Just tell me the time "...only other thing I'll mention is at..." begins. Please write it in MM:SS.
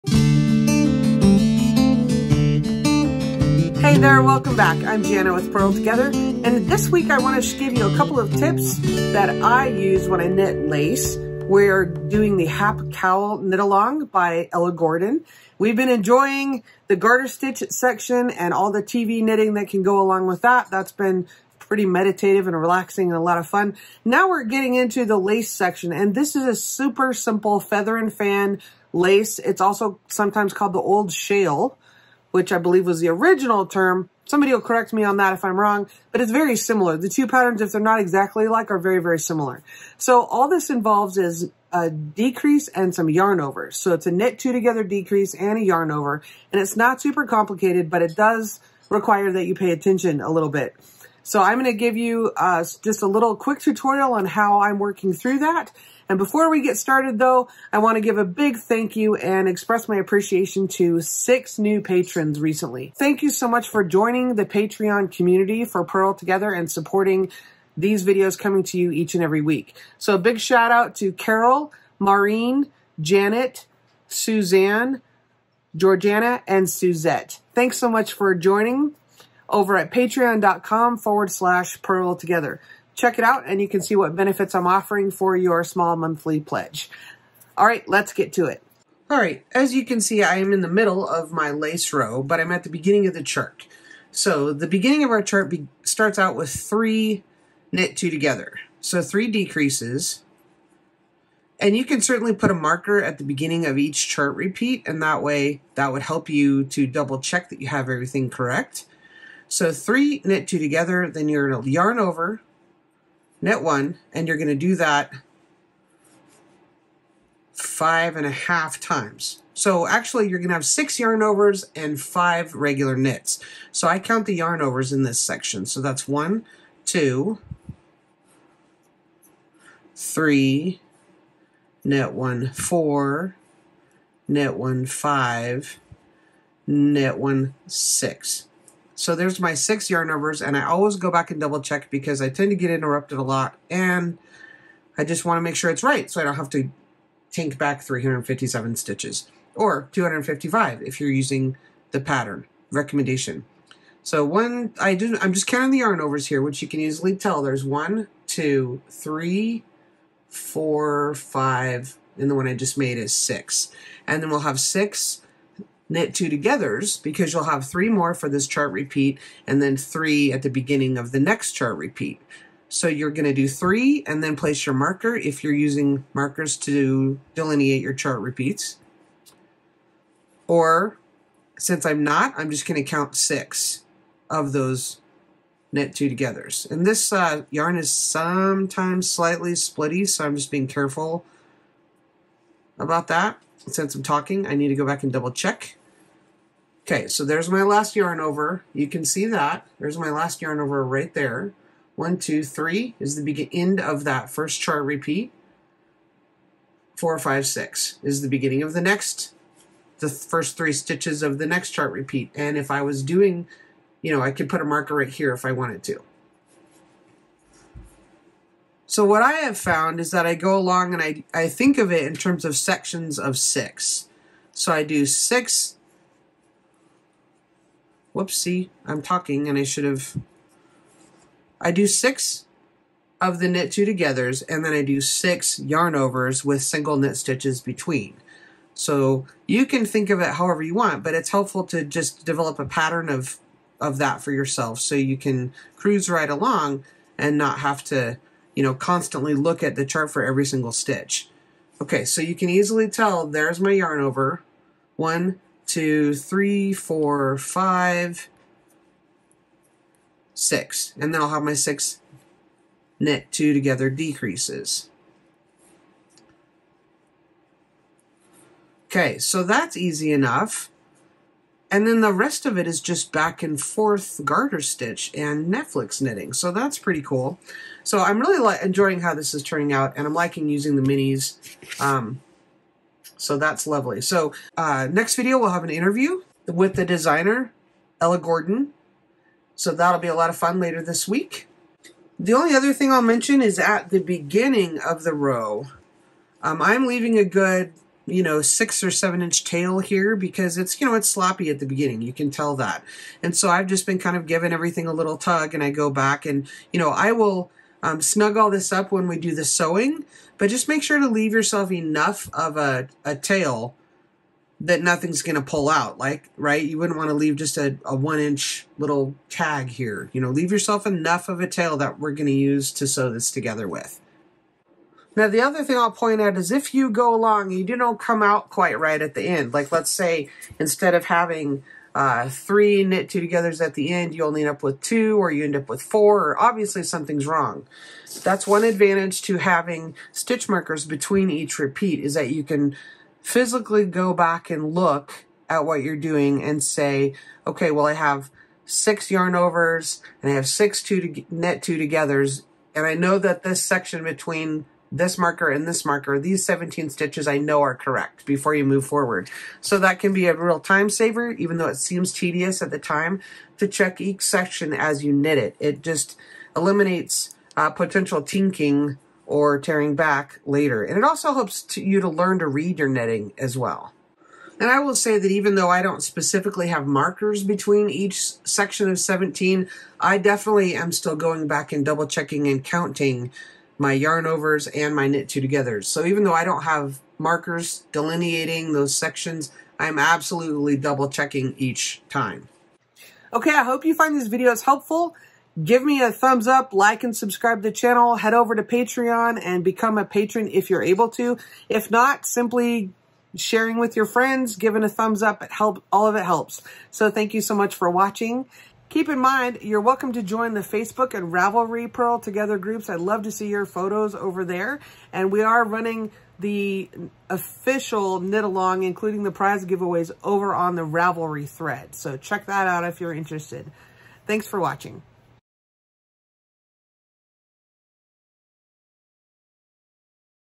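04:52.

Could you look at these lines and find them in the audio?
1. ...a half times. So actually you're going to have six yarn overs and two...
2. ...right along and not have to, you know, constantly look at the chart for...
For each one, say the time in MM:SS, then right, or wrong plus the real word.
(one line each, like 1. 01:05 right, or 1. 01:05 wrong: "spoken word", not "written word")
1. 01:58 wrong: "five", not "two"
2. 04:06 right.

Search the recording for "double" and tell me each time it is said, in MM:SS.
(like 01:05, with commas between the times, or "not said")
01:46, 02:21, 03:15, 06:21, 06:30.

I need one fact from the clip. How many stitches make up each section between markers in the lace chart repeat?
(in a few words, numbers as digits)
17.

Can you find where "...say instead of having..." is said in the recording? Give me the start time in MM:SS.
05:29.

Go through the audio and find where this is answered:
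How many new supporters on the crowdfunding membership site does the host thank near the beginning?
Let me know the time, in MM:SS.
01:01.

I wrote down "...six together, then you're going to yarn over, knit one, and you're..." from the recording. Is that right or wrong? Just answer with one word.
wrong.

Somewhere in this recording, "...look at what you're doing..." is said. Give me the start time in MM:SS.
05:44.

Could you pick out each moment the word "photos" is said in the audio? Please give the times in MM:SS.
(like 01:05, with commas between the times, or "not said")
06:53.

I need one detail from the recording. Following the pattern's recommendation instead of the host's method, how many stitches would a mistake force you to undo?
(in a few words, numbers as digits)
255.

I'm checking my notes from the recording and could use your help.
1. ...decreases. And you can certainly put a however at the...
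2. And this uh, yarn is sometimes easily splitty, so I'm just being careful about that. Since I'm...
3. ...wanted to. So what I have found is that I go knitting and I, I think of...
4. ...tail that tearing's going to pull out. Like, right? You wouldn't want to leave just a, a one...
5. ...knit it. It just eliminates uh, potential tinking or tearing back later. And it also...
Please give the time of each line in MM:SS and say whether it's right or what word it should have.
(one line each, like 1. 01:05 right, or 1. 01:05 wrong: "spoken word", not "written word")
1. 01:39 wrong: "marker", not "however"
2. 03:06 wrong: "slightly", not "easily"
3. 03:35 wrong: "along", not "knitting"
4. 05:13 wrong: "nothing", not "tearing"
5. 06:05 right.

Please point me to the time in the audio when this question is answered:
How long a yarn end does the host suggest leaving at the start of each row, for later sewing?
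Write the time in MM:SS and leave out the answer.
04:58.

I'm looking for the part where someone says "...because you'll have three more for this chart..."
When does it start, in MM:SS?
02:47.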